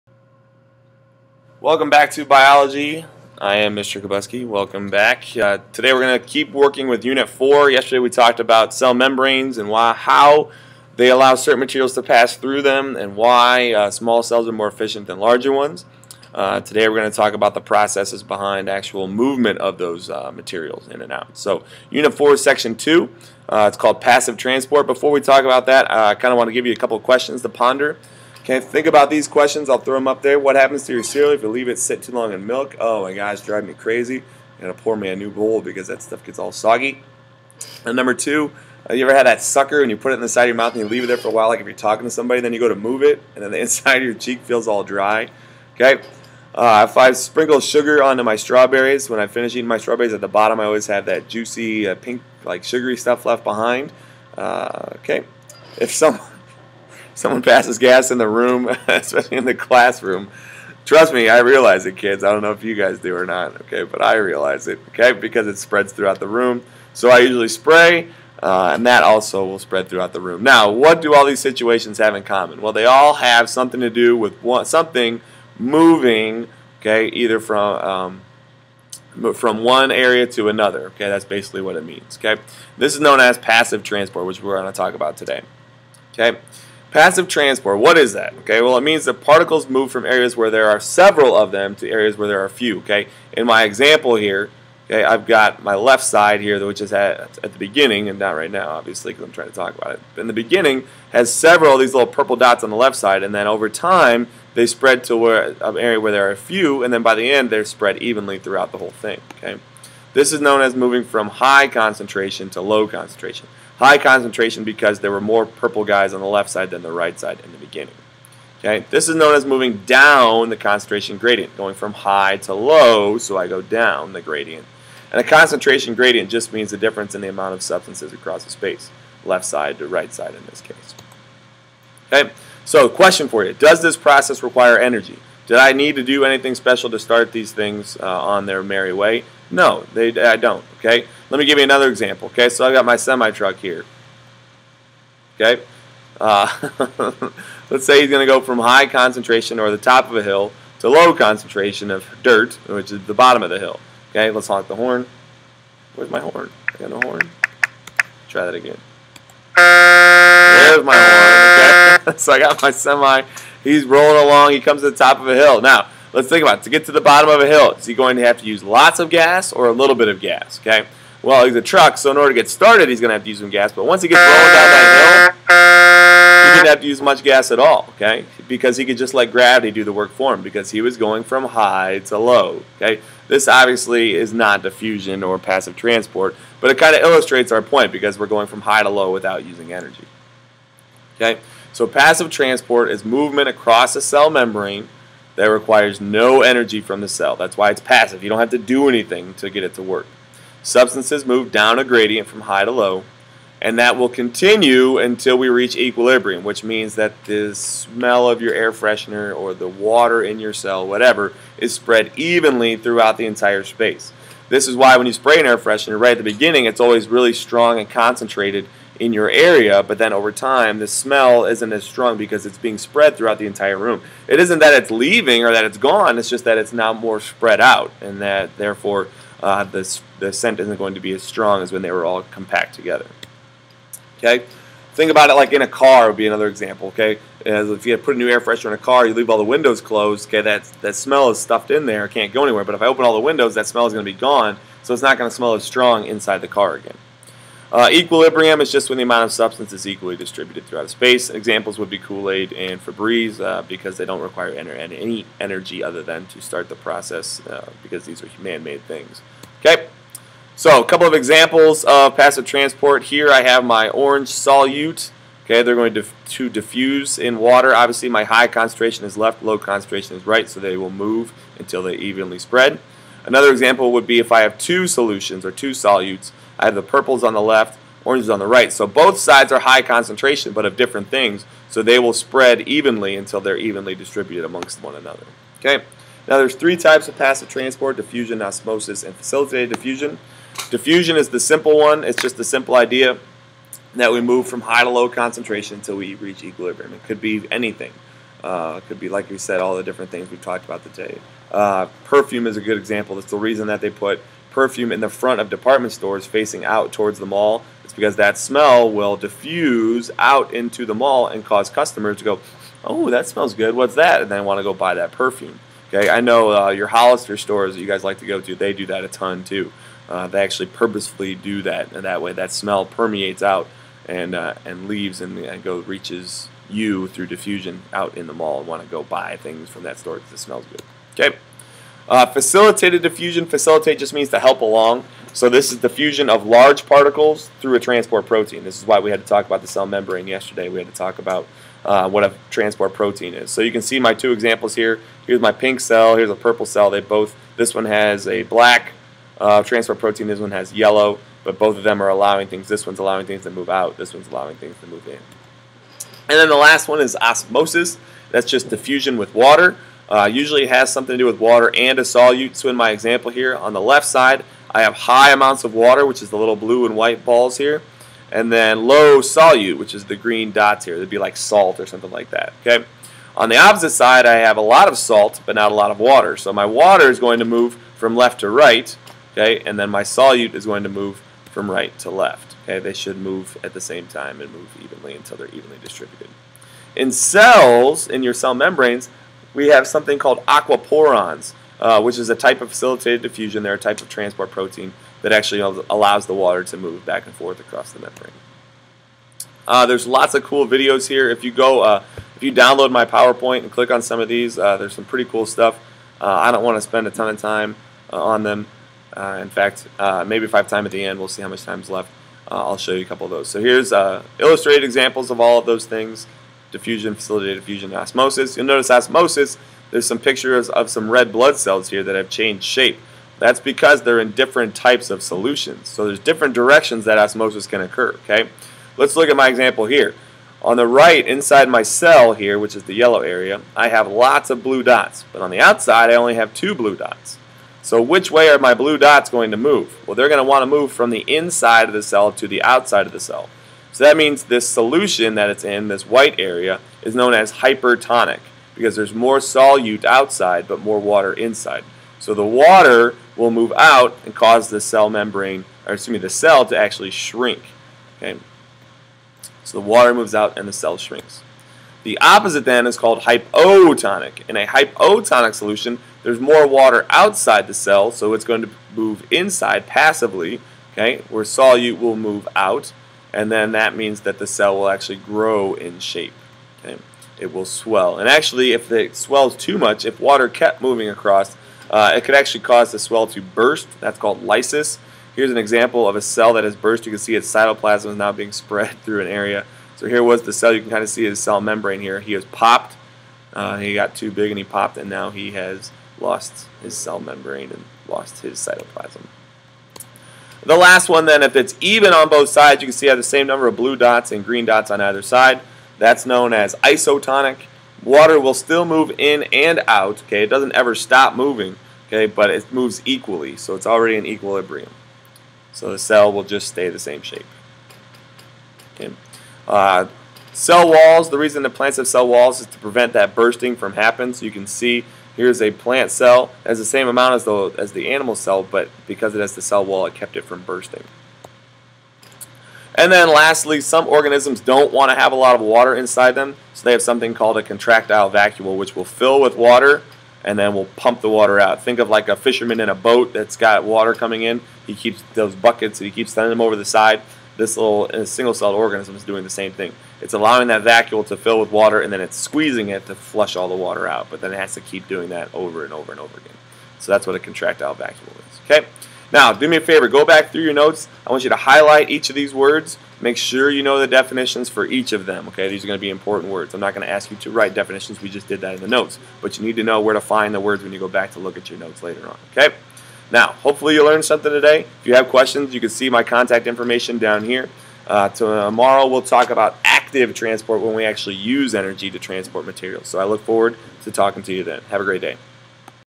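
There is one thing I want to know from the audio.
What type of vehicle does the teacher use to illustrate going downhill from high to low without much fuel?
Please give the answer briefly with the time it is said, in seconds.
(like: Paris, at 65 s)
semi truck, at 142 s.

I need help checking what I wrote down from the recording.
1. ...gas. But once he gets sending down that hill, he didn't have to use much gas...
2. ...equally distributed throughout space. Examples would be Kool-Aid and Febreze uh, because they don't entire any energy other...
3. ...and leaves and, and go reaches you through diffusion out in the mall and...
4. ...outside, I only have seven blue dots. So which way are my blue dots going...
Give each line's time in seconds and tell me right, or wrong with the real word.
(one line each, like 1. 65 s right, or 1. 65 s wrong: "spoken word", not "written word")
1. 173 s wrong: "rolling", not "sending"
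2. 249 s wrong: "require", not "entire"
3. 324 s right
4. 435 s wrong: "two", not "seven".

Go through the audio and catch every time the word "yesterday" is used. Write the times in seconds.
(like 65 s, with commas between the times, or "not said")
7 s, 340 s.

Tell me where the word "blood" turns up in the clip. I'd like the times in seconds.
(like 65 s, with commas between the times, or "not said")
421 s.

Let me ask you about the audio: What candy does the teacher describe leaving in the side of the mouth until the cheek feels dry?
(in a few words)
sucker.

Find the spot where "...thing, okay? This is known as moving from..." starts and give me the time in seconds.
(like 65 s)
108 s.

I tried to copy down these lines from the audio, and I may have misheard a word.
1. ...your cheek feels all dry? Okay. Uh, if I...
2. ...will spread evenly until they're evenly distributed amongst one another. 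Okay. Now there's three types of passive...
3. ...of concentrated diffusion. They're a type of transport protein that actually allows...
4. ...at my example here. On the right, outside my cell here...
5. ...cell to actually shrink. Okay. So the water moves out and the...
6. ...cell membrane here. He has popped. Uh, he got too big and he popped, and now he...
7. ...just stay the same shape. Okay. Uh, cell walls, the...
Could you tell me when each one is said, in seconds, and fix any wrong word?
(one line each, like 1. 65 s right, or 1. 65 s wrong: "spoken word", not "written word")
1. 44 s right
2. 281 s right
3. 392 s wrong: "facilitated", not "concentrated"
4. 429 s wrong: "inside", not "outside"
5. 456 s right
6. 491 s right
7. 516 s right.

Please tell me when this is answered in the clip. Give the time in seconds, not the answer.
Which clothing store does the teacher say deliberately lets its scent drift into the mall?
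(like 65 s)
316 s.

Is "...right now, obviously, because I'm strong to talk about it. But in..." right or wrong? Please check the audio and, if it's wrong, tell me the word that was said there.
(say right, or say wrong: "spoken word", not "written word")
wrong: "trying", not "strong".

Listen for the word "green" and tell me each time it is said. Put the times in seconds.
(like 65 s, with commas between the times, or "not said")
370 s, 504 s.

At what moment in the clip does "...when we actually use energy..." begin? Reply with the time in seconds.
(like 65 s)
580 s.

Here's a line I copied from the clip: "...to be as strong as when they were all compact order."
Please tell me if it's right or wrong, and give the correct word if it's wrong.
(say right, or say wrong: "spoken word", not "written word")
wrong: "together", not "order".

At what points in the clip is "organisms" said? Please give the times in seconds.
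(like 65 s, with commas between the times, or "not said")
534 s, 548 s.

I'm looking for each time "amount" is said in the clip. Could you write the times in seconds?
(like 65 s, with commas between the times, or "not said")
127 s, 249 s, 365 s, 527 s.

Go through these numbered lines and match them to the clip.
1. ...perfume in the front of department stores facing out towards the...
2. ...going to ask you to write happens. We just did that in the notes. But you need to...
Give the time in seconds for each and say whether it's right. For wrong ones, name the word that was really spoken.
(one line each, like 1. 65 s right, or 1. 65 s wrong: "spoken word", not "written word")
1. 304 s right
2. 566 s wrong: "definitions", not "happens".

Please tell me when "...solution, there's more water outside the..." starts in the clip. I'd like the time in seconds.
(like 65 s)
465 s.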